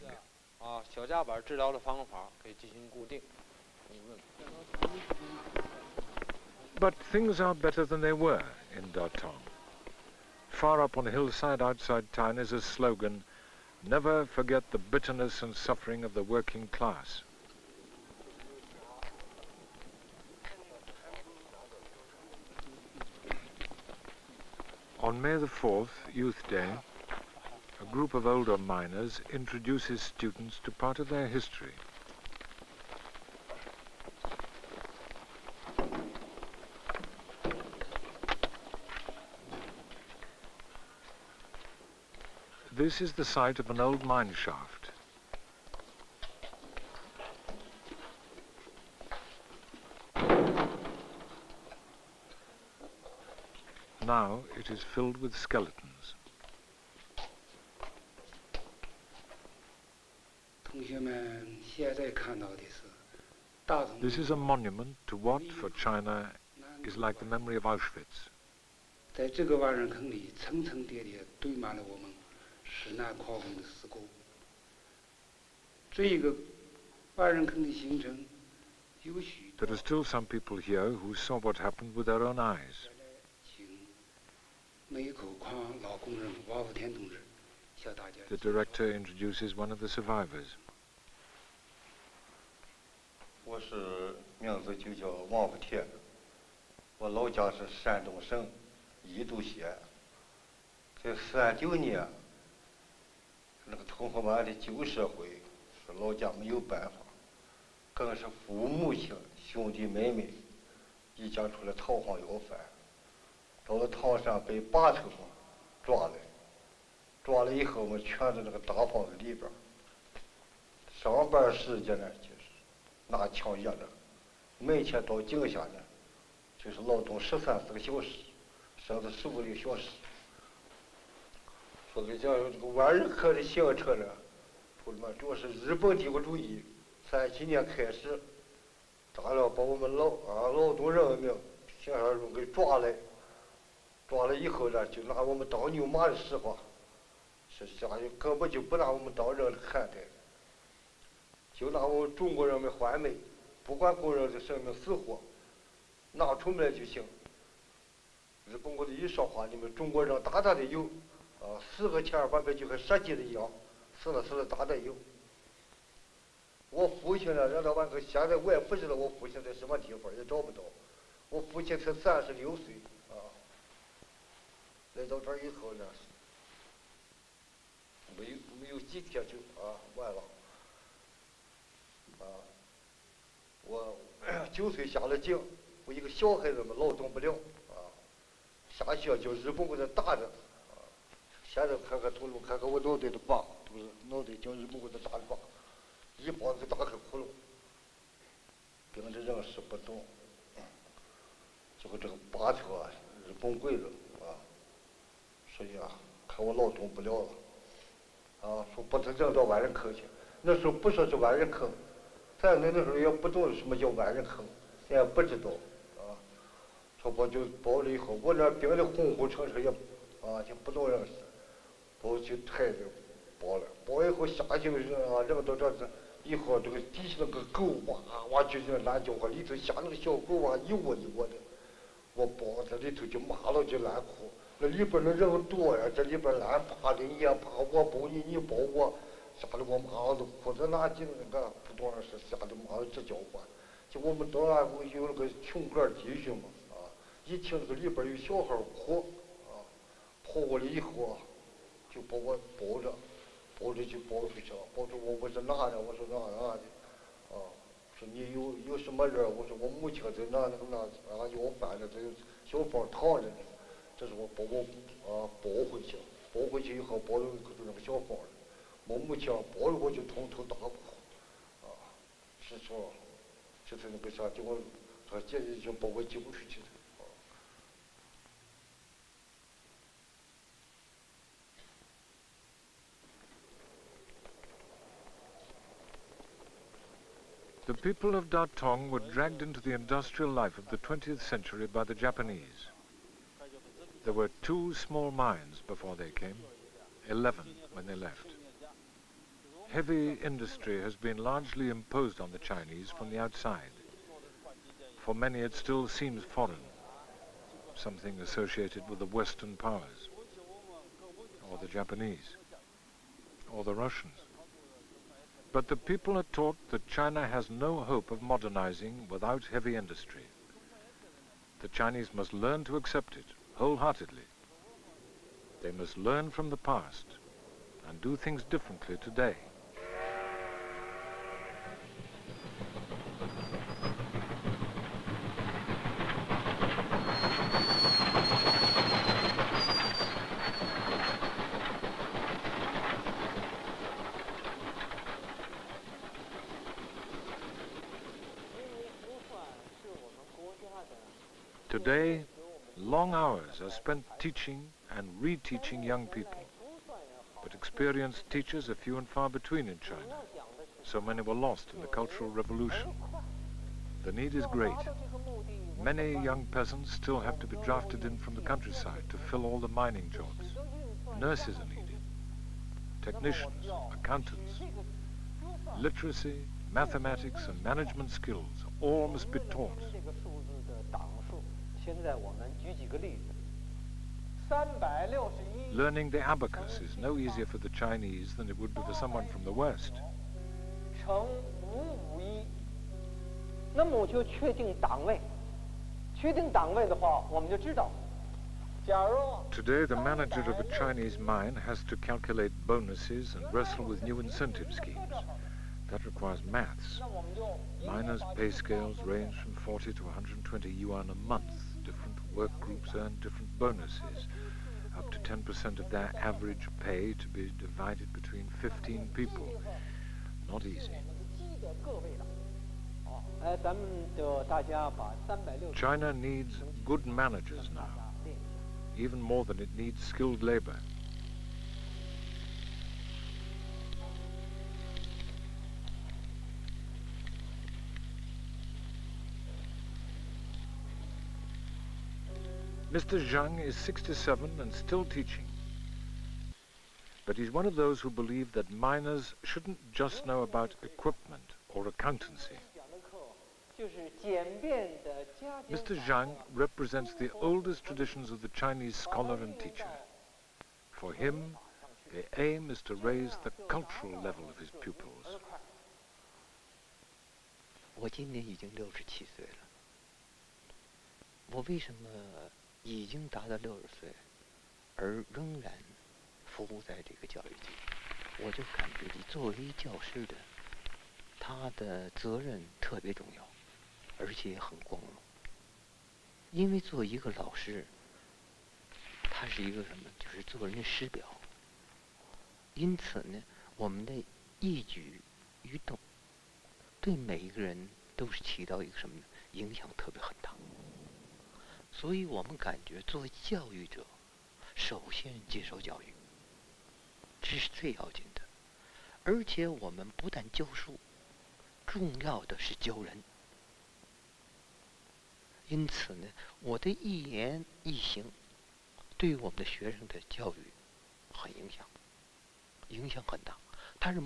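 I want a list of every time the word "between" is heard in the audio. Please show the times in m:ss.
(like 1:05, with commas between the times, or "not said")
5:59, 6:58.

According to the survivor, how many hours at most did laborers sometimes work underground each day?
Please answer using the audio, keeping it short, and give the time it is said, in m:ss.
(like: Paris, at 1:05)
15 hours, at 2:09.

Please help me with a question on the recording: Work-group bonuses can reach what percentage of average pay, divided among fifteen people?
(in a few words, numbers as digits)
10%.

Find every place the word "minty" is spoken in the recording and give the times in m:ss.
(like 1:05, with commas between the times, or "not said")
not said.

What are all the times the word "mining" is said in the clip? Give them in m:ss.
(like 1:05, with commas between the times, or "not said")
6:09.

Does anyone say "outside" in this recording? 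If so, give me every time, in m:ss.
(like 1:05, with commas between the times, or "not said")
0:11, 5:03.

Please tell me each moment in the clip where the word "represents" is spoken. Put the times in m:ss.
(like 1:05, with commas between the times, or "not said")
7:36.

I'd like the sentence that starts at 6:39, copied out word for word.
Today, the manager of a Chinese mine has to calculate bonuses and wrestle with new incentive schemes.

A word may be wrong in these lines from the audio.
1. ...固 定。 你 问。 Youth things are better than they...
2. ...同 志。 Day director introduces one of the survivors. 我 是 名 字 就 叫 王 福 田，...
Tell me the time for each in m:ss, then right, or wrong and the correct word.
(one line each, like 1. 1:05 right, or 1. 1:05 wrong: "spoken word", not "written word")
1. 0:02 wrong: "But", not "Youth"
2. 1:26 wrong: "The", not "Day".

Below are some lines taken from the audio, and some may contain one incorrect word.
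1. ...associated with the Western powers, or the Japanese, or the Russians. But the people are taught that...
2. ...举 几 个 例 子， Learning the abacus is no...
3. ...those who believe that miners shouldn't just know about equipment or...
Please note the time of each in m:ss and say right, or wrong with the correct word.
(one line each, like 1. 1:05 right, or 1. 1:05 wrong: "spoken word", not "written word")
1. 5:08 right
2. 6:22 right
3. 7:27 right.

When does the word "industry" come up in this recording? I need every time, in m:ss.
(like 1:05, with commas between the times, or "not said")
5:00, 5:19.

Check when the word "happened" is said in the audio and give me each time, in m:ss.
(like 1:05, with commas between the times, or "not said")
1:21.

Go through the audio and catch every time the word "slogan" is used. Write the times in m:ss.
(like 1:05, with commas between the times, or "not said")
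0:12.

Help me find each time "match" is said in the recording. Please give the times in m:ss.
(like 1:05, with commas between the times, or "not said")
not said.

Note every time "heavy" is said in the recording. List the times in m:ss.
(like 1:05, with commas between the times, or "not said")
4:59, 5:19.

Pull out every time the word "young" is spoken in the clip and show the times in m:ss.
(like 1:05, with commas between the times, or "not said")
5:55, 6:06.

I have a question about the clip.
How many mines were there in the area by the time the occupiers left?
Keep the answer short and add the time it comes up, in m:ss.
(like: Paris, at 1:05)
11, at 4:57.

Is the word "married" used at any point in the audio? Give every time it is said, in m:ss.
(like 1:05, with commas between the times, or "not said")
not said.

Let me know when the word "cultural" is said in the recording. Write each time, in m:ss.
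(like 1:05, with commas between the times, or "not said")
6:01, 7:43.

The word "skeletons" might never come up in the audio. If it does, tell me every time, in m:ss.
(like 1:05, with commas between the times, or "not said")
0:55.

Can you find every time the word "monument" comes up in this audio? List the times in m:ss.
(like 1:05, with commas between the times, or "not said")
1:04.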